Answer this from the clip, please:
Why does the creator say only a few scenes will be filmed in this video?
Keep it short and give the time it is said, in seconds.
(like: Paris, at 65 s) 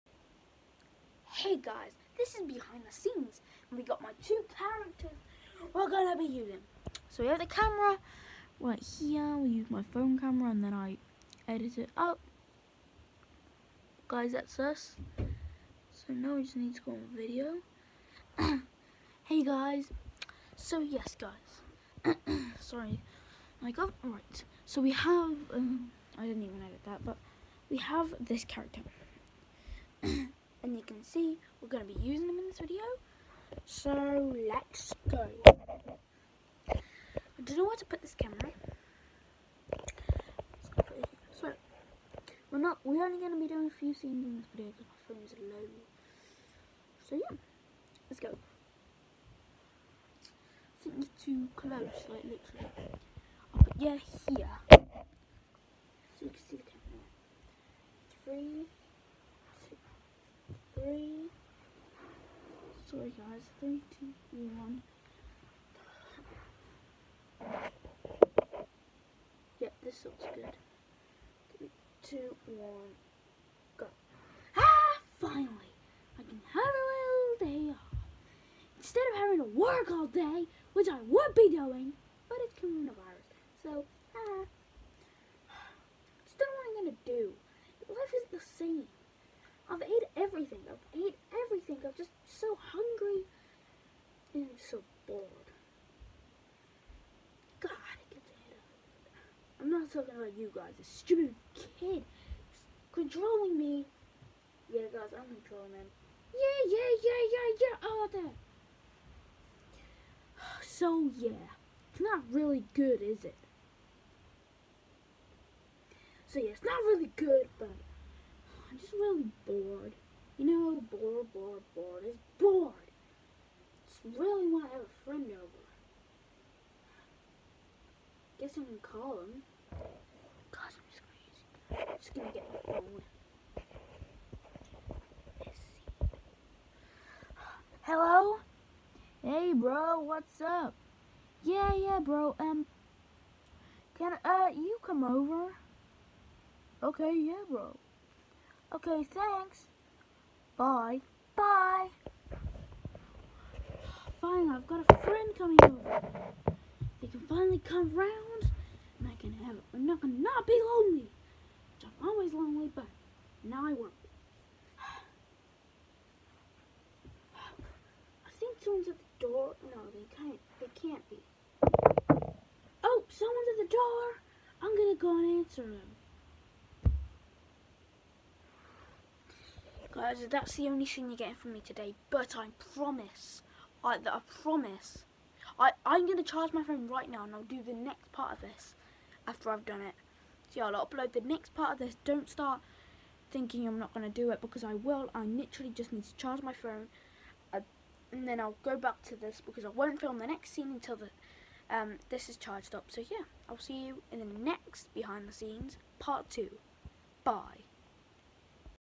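phone's low, at 44 s.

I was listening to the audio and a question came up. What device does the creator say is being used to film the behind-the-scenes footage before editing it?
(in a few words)
phone camera.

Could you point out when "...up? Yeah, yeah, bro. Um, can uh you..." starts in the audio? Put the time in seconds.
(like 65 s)
140 s.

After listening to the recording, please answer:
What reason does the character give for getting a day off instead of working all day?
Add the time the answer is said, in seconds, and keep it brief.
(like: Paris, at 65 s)
coronavirus, at 82 s.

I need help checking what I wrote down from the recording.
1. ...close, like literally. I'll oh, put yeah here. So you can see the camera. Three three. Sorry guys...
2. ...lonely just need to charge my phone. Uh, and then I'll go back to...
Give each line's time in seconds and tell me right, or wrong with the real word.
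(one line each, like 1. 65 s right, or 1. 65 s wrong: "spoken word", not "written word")
1. 51 s right
2. 195 s wrong: "literally", not "lonely".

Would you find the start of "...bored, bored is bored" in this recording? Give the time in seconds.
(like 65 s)
121 s.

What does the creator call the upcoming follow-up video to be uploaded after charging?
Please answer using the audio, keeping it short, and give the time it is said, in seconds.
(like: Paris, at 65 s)
behind the scenes part two, at 204 s.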